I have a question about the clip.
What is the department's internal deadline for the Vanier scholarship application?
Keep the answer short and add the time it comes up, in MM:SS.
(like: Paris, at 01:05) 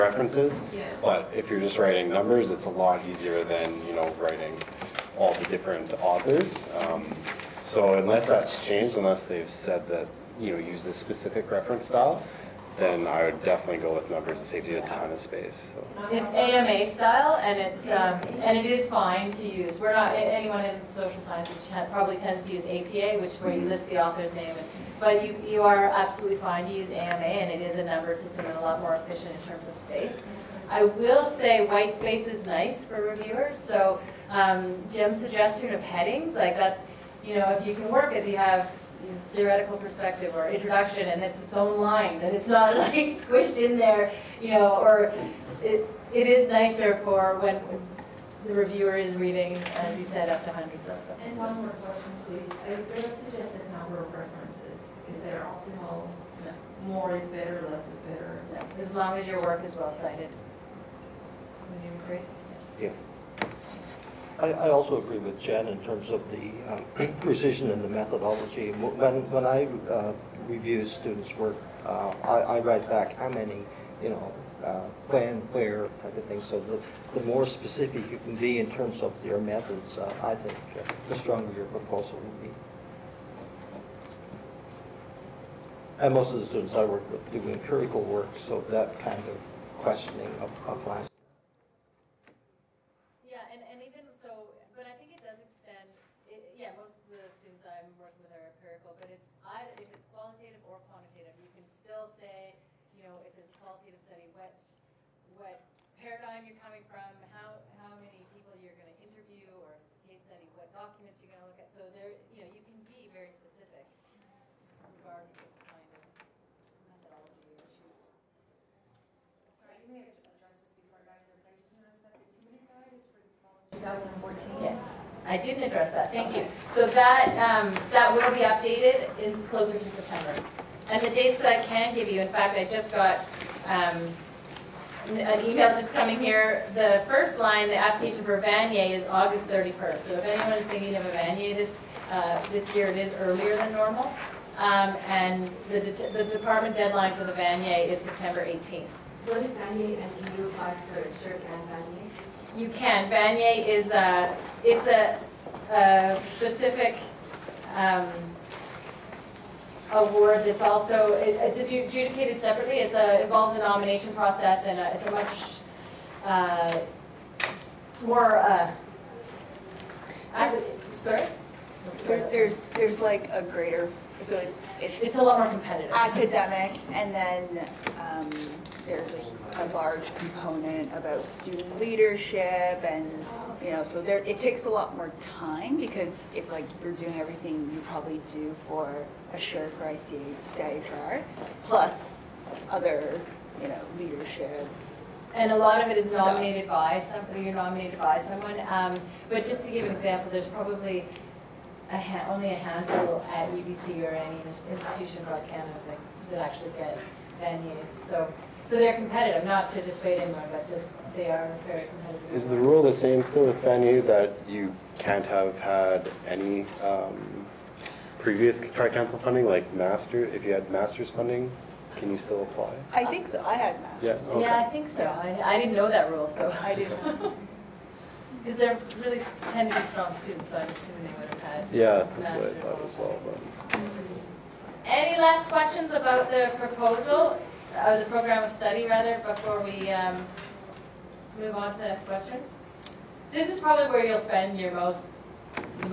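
September 18, at 02:27.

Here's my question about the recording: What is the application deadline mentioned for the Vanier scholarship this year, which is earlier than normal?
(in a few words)
August 31.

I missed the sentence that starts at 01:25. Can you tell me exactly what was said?
And most of the students I work with do empirical work, so that kind of questioning applies to them.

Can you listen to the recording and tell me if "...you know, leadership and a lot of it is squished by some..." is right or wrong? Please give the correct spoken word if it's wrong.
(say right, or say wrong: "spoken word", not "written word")
wrong: "nominated", not "squished".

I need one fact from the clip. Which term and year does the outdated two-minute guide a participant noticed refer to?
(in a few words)
Fall 2014.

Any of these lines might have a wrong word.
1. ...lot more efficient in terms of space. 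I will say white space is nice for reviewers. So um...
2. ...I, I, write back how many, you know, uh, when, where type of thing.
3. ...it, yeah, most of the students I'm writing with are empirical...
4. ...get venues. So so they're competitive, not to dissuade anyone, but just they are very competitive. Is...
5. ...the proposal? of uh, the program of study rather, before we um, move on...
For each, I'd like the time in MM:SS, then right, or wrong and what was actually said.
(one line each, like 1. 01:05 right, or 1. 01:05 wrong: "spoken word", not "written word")
1. 00:28 right
2. 01:12 right
3. 01:36 wrong: "working", not "writing"
4. 03:26 right
5. 03:56 right.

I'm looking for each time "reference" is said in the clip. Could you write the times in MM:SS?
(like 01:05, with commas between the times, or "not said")
00:11, 00:54.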